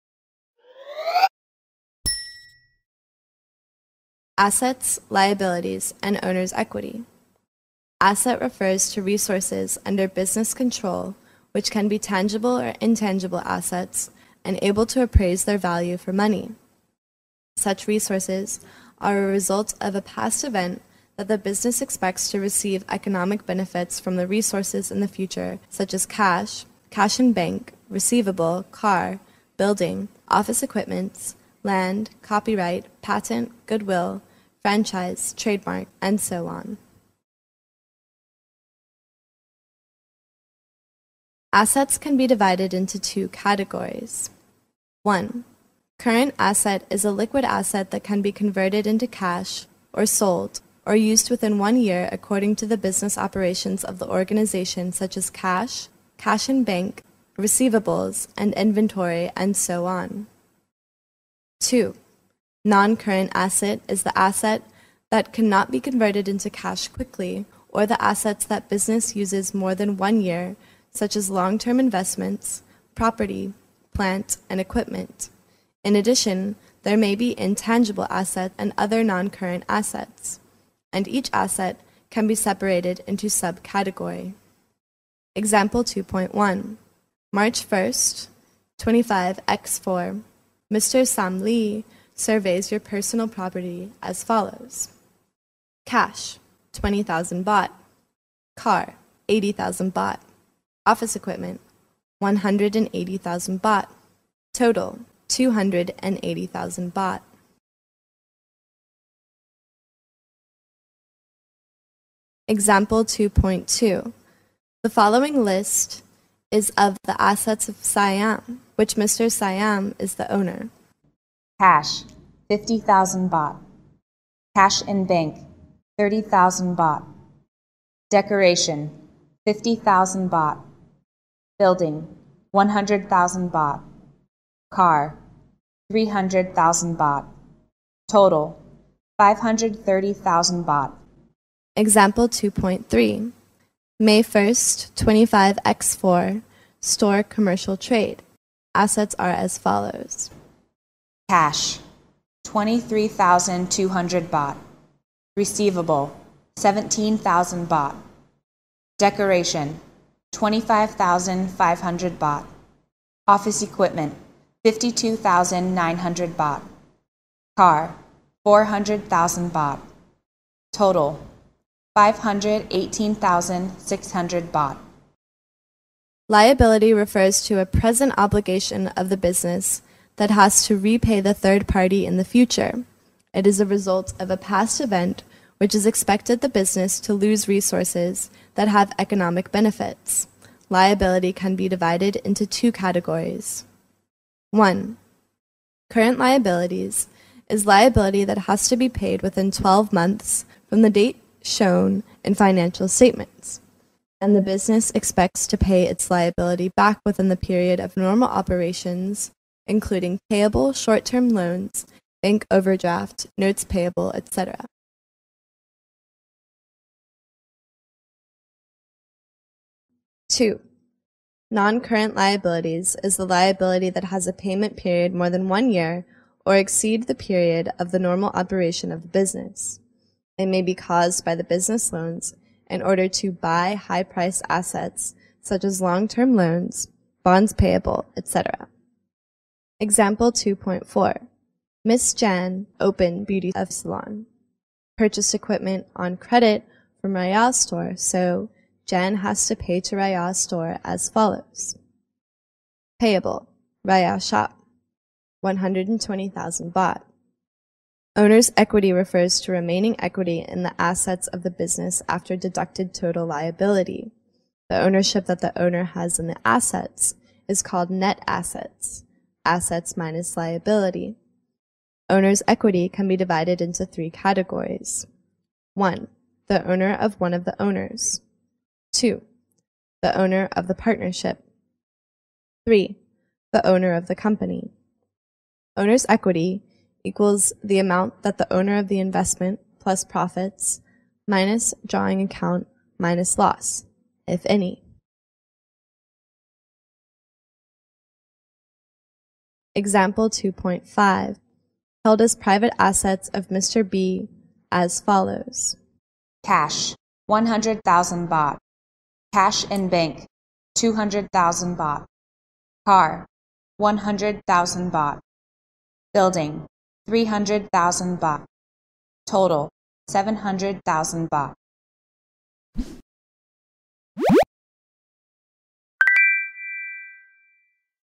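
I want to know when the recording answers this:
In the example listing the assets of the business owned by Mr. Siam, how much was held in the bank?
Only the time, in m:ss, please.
2:05.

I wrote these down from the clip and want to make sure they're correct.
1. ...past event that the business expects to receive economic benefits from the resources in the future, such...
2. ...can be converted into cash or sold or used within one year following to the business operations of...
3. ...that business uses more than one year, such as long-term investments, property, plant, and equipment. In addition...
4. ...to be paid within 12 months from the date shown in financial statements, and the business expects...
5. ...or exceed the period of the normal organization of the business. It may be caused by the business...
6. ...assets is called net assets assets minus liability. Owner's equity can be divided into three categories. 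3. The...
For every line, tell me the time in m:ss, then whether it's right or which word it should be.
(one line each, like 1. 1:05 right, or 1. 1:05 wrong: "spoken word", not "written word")
1. 0:20 right
2. 0:48 wrong: "according", not "following"
3. 1:08 right
4. 3:18 right
5. 3:46 wrong: "operation", not "organization"
6. 4:26 wrong: "1", not "3".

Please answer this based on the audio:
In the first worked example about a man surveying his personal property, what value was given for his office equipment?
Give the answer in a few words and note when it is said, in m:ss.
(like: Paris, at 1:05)
180,000 baht, at 1:42.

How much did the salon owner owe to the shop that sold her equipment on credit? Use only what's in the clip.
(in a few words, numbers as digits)
120,000 baht.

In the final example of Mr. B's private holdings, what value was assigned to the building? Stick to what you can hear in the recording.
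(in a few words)
300,000 baht.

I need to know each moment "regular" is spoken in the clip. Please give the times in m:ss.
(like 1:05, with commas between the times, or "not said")
not said.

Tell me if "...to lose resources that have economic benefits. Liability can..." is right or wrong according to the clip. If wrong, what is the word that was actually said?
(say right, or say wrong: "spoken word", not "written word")
right.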